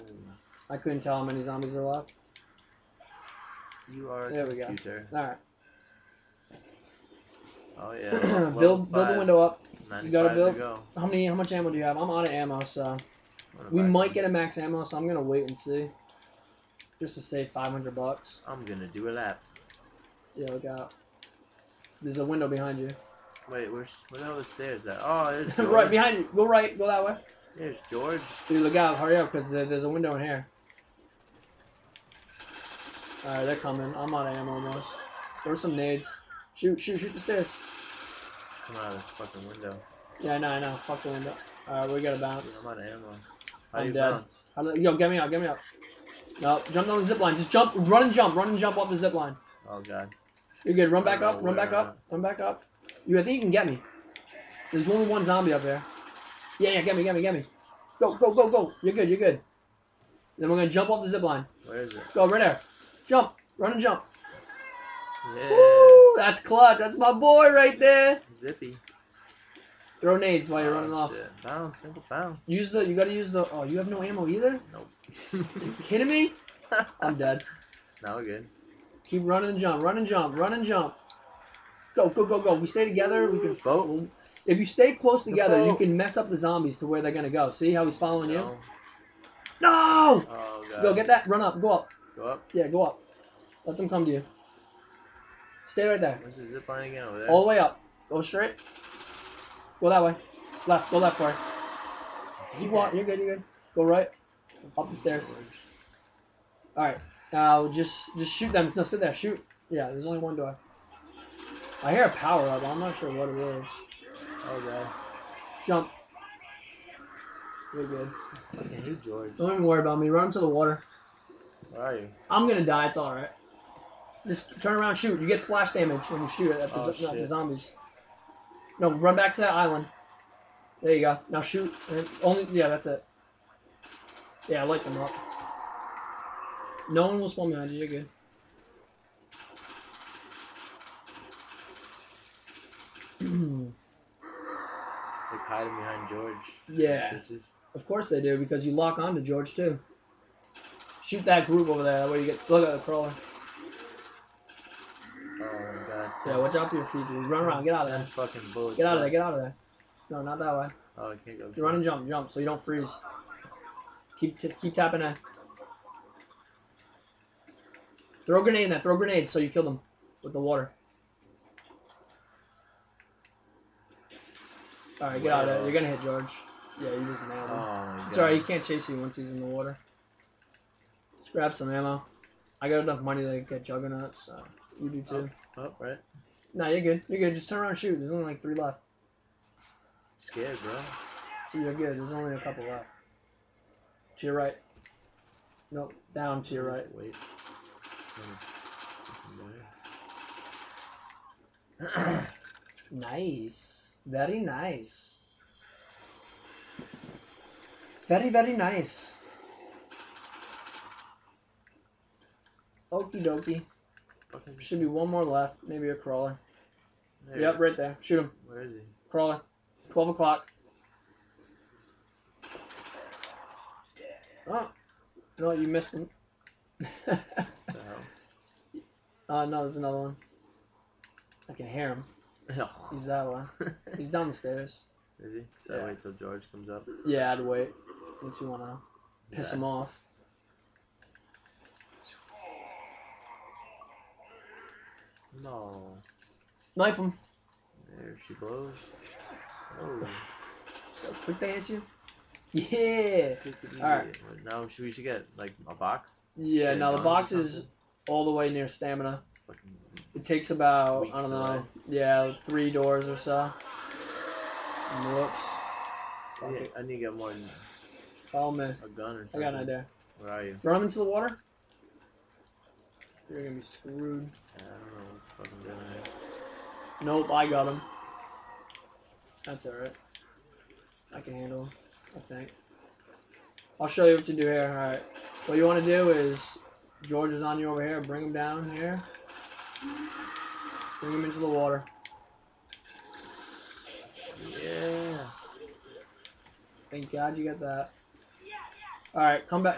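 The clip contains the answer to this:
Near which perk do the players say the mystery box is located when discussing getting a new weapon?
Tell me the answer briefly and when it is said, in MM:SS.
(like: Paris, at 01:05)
Stamina, at 04:18.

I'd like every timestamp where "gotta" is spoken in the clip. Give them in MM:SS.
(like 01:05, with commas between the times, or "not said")
00:10, 00:42, 01:12.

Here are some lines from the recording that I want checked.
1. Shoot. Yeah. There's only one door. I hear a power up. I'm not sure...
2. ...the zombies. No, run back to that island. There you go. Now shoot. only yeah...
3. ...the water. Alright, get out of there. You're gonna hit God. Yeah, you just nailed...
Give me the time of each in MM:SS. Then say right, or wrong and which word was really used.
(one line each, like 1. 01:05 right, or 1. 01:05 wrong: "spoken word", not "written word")
1. 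01:49 right
2. 02:07 right
3. 02:50 wrong: "George", not "God".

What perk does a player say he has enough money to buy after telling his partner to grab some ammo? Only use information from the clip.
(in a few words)
Juggernaut.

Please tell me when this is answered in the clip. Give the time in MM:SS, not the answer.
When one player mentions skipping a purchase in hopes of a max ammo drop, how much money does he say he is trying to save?
00:17.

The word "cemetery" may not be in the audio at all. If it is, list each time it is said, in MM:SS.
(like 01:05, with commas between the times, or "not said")
not said.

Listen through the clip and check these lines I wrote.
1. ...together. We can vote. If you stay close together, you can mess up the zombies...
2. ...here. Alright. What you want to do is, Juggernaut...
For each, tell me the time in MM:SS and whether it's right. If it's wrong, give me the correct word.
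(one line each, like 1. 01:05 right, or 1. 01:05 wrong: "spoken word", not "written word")
1. 01:22 right
2. 04:44 wrong: "George", not "Juggernaut".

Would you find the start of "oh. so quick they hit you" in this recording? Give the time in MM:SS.
04:10.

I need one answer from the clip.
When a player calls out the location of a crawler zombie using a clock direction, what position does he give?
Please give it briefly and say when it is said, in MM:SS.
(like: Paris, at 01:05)
12 o'clock, at 03:39.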